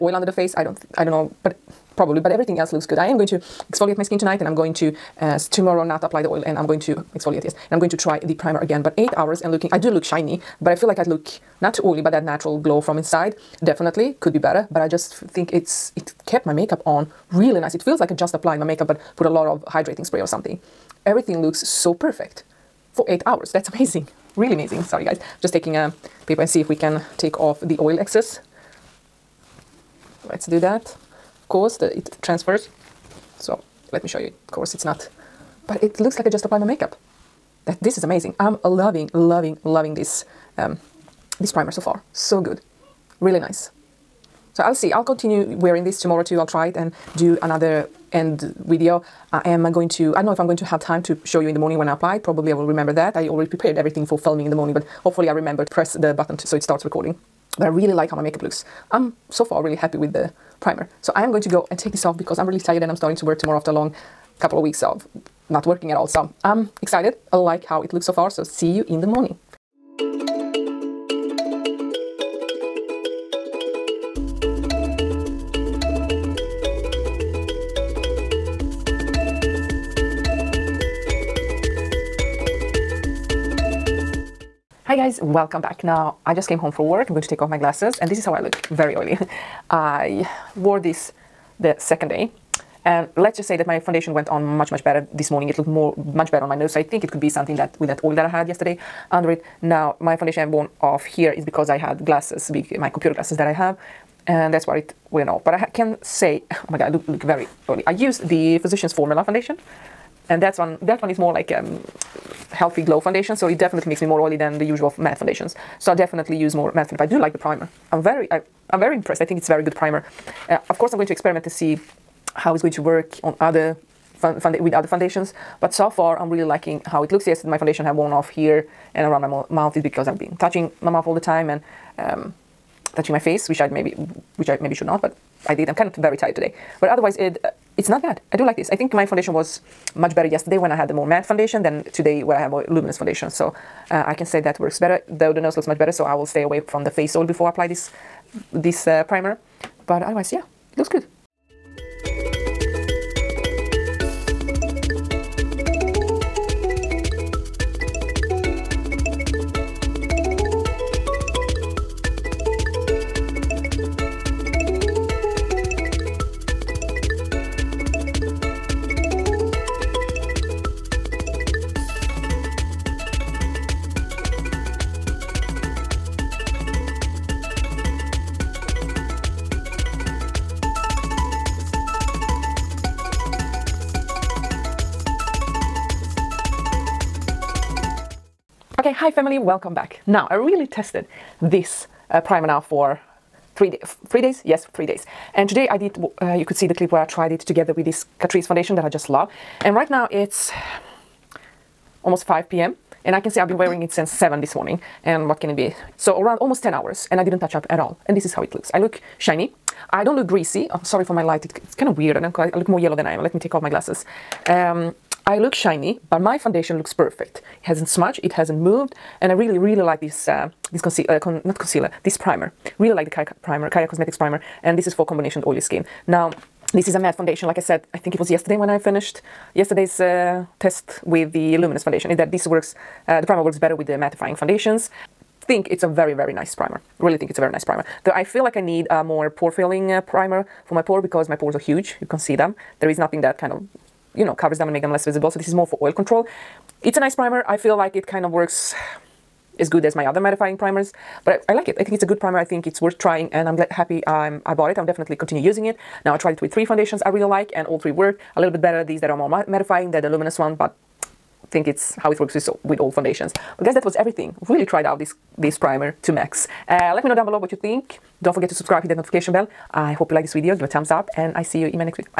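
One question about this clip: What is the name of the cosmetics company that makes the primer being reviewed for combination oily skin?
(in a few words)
Caia Cosmetics.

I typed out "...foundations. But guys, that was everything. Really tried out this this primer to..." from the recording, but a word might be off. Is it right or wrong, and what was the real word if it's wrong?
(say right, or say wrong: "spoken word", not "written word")
right.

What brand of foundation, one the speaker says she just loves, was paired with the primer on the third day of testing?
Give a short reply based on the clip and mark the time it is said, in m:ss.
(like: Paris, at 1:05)
Catrice, at 3:18.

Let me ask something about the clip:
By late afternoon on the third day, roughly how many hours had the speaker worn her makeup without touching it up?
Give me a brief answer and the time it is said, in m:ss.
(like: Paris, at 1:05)
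10, at 3:26.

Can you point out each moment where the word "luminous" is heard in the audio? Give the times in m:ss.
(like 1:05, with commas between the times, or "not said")
2:22, 3:51, 4:20.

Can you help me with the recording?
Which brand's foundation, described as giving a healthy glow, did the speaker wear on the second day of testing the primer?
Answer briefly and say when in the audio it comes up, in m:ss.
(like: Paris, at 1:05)
Physicians Formula, at 1:48.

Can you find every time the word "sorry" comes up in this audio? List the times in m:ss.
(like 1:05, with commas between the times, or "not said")
0:24, 3:30.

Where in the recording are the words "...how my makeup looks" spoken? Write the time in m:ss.
0:58.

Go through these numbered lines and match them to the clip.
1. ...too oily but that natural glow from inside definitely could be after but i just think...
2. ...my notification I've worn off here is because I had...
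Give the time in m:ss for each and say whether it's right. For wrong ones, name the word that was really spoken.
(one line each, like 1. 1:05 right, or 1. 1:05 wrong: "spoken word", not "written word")
1. 0:11 wrong: "better", not "after"
2. 1:40 wrong: "foundation", not "notification".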